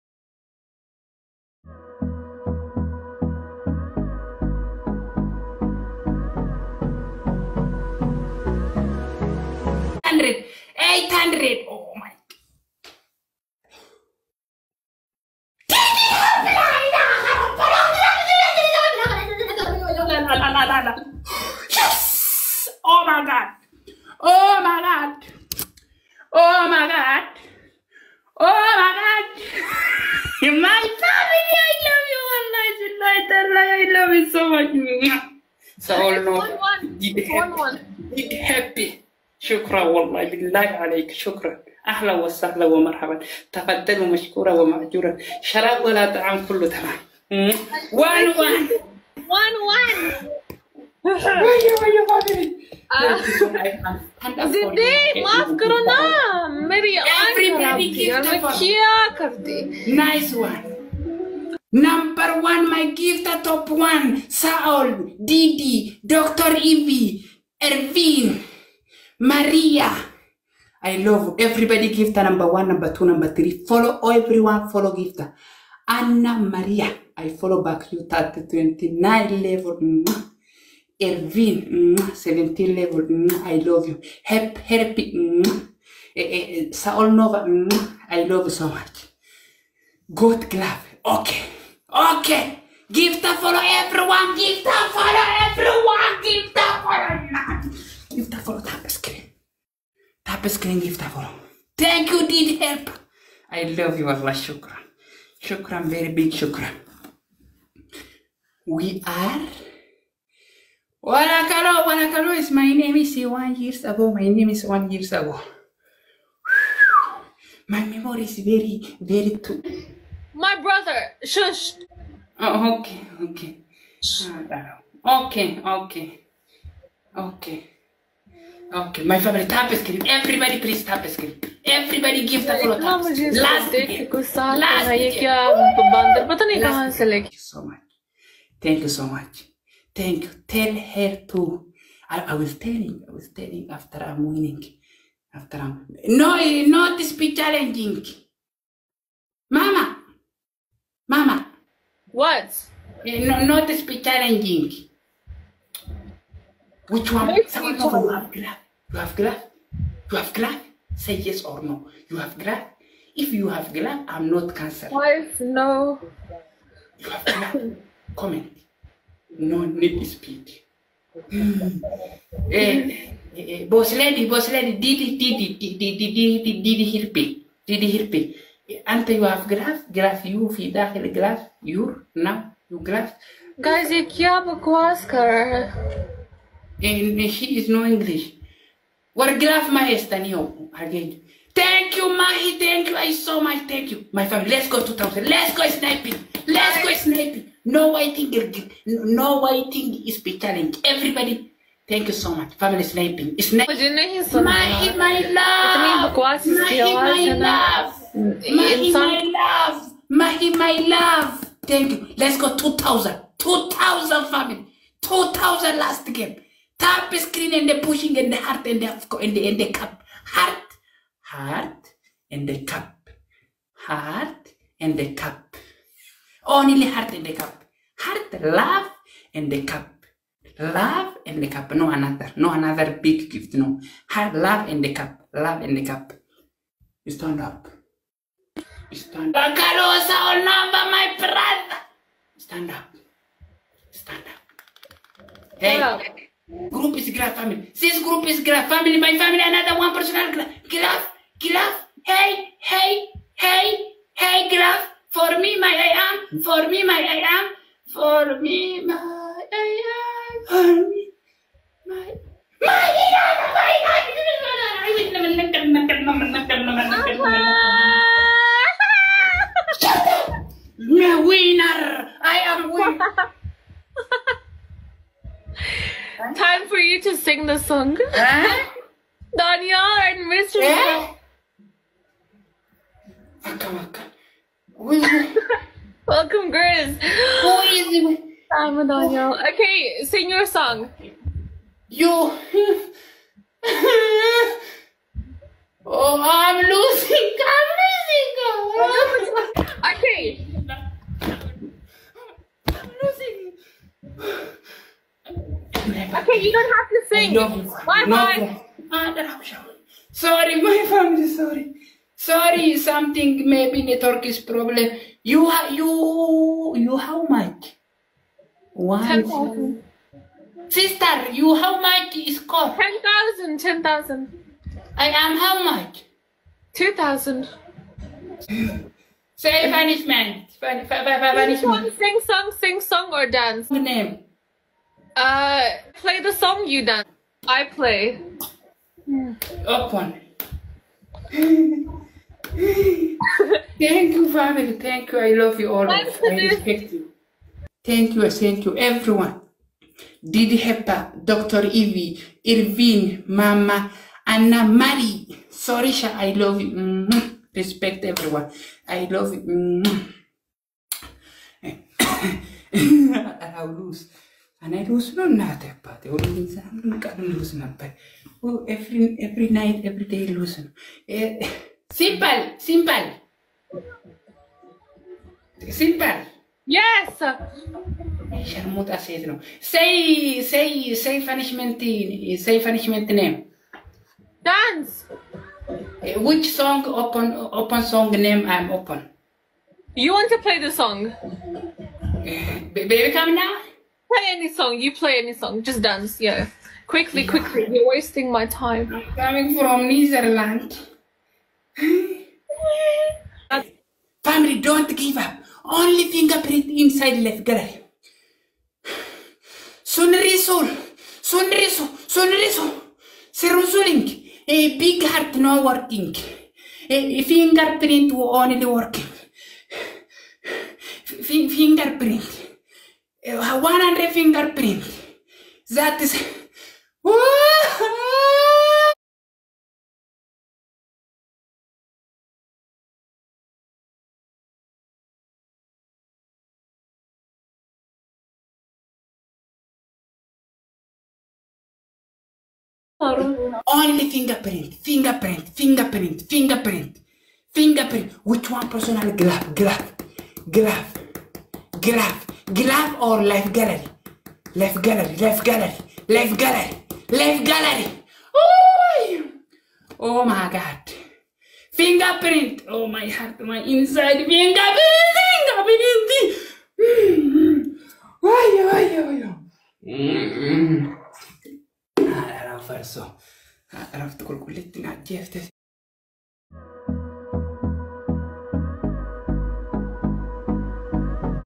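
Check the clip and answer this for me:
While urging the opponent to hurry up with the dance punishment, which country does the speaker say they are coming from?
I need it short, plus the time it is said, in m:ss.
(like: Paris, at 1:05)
Netherlands, at 6:39.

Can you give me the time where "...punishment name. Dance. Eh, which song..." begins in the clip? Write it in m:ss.
6:22.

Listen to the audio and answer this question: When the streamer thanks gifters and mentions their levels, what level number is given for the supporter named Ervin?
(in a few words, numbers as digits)
17.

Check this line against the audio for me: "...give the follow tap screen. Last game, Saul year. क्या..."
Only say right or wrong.
wrong.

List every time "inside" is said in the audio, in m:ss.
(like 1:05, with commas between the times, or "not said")
6:46, 7:43.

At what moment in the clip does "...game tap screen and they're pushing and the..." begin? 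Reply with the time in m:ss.
3:36.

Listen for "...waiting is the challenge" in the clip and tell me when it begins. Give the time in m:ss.
3:19.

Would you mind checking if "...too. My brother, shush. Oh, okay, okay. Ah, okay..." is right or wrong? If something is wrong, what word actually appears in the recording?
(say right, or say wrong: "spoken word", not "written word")
right.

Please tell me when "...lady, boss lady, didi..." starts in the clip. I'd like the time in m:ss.
2:53.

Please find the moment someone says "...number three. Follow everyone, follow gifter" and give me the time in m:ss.
1:13.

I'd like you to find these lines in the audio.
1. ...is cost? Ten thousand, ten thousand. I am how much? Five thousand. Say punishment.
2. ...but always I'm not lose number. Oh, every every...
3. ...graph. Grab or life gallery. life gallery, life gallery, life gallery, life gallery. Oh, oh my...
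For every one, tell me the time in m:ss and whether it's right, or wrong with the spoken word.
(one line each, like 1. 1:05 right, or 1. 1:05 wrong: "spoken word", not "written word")
1. 5:22 wrong: "Two", not "Five"
2. 6:05 right
3. 7:31 right.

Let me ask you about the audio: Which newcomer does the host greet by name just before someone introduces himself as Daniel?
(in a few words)
Grizz.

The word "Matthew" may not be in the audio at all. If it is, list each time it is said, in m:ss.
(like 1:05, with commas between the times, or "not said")
not said.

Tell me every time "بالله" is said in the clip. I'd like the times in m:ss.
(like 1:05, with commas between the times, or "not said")
0:40.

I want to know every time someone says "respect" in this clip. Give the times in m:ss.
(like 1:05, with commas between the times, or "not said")
5:46, 5:57.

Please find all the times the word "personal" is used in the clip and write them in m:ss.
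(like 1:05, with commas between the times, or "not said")
4:09, 7:28.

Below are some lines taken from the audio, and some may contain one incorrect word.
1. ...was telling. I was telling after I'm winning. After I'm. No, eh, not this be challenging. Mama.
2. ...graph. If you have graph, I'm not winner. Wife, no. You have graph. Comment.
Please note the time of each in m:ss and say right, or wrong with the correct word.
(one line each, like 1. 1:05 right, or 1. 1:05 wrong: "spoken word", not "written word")
1. 2:22 right
2. 2:42 wrong: "cancer", not "winner".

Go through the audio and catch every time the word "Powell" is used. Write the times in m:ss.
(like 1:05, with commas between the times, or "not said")
not said.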